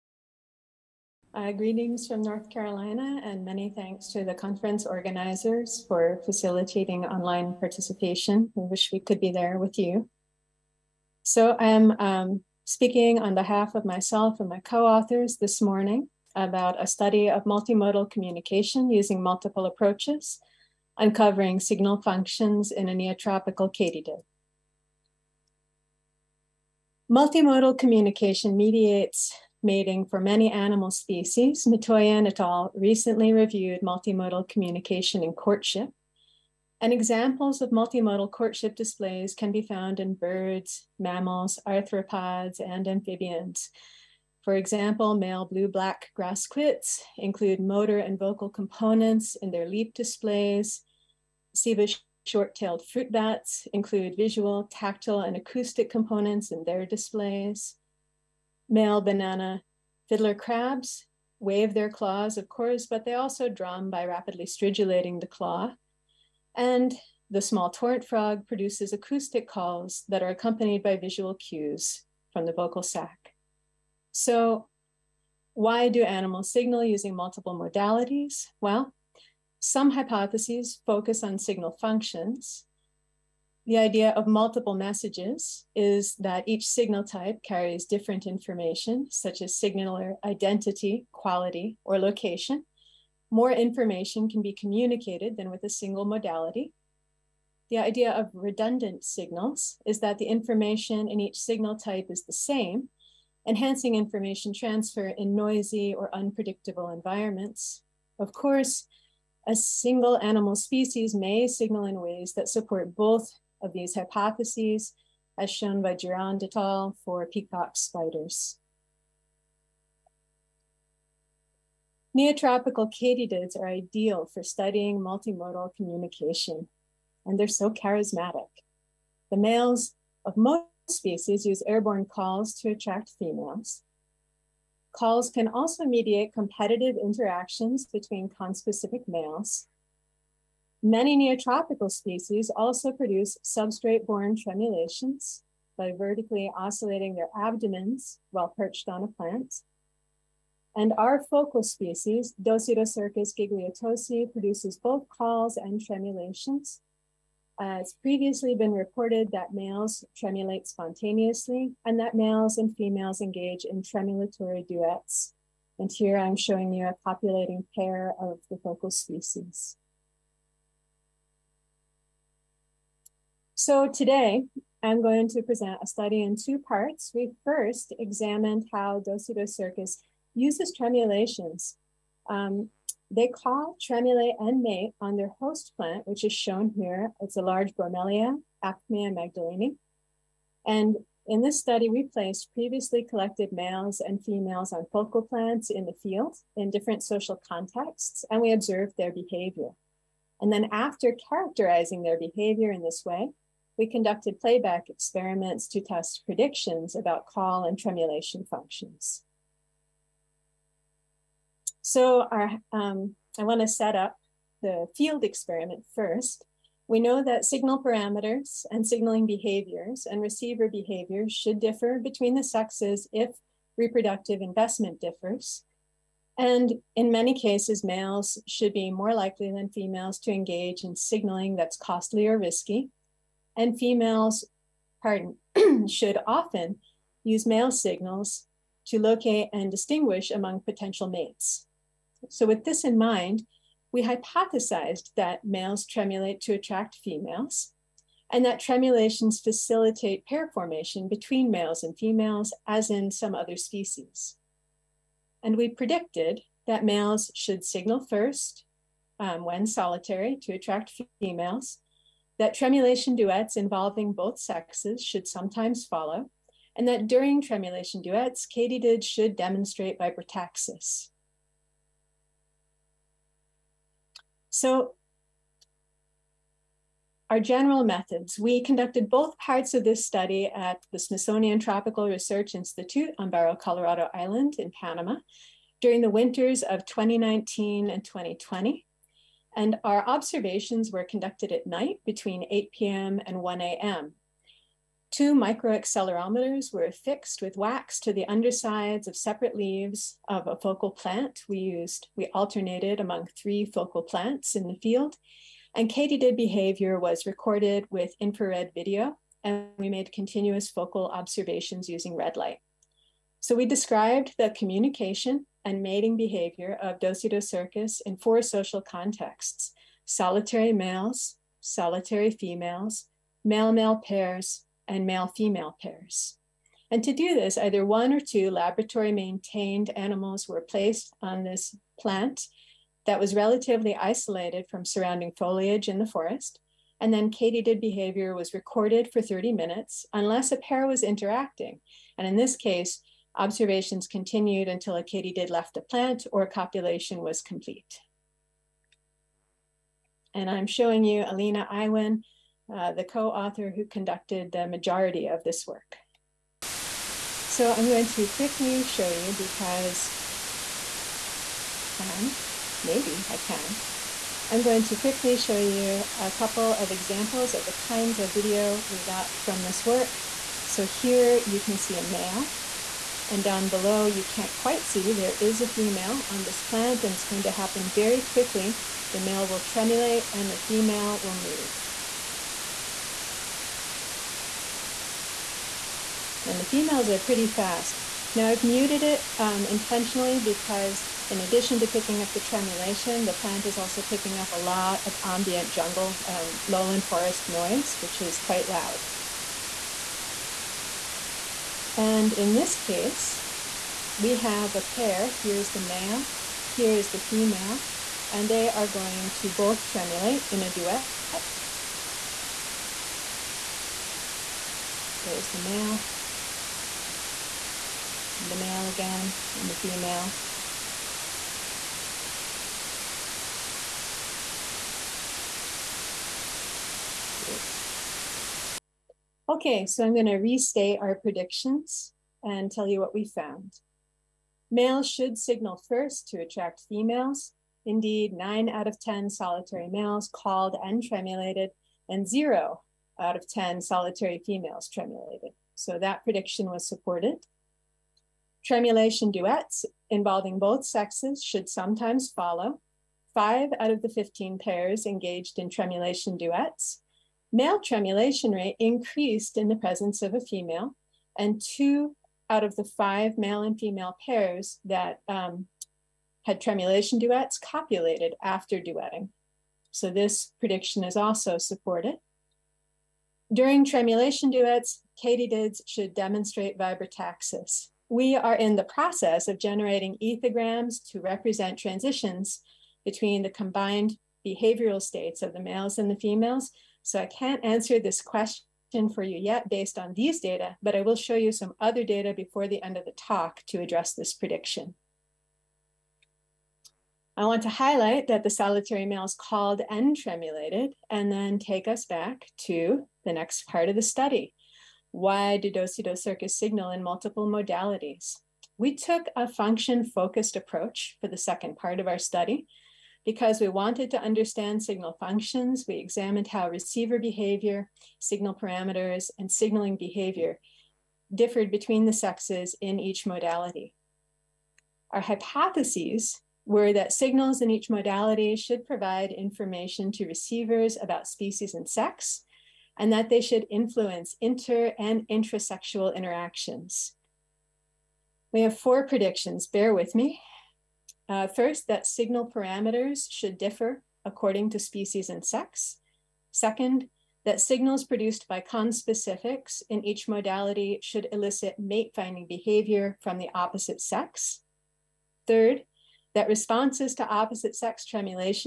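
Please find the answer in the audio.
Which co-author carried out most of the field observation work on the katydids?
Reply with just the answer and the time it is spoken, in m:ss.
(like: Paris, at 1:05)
Alina Iwan, at 5:51.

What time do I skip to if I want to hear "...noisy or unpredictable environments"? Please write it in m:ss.
1:45.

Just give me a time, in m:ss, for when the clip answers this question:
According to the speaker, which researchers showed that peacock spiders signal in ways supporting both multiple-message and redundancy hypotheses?
1:55.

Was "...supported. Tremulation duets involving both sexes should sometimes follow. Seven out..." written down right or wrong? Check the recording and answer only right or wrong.
wrong.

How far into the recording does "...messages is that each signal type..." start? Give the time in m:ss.
1:24.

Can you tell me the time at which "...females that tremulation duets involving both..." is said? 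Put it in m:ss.
4:21.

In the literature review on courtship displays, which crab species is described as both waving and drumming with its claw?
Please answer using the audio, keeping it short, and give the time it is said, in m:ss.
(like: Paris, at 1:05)
banana fiddler crabs, at 0:59.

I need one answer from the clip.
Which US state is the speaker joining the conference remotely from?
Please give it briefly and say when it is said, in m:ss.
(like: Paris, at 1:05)
North Carolina, at 0:02.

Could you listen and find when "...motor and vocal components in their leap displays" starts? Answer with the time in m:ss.
0:47.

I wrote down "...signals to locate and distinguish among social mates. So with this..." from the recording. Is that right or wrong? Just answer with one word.
wrong.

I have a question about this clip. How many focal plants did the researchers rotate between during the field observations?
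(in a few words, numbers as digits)
3.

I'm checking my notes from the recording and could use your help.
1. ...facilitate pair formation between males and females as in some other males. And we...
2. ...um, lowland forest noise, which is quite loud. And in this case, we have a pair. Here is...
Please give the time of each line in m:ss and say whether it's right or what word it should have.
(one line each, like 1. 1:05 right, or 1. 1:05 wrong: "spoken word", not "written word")
1. 4:09 wrong: "species", not "males"
2. 6:36 right.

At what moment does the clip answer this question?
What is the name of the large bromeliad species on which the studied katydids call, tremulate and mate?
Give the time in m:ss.
3:08.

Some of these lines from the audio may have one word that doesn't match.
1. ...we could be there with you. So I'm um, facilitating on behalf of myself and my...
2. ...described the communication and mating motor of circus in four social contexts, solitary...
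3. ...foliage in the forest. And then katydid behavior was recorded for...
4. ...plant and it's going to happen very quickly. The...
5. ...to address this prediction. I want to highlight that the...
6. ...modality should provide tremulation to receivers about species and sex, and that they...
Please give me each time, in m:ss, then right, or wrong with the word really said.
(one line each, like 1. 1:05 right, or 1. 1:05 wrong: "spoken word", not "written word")
1. 0:08 wrong: "speaking", not "facilitating"
2. 5:13 wrong: "behavior", not "motor"
3. 5:35 right
4. 6:16 right
5. 8:13 right
6. 8:47 wrong: "information", not "tremulation".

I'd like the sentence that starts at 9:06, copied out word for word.
Second, that signals produced by conspecifics in each modality should elicit mate finding behavior from the opposite sex.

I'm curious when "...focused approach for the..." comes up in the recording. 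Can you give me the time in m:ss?
8:30.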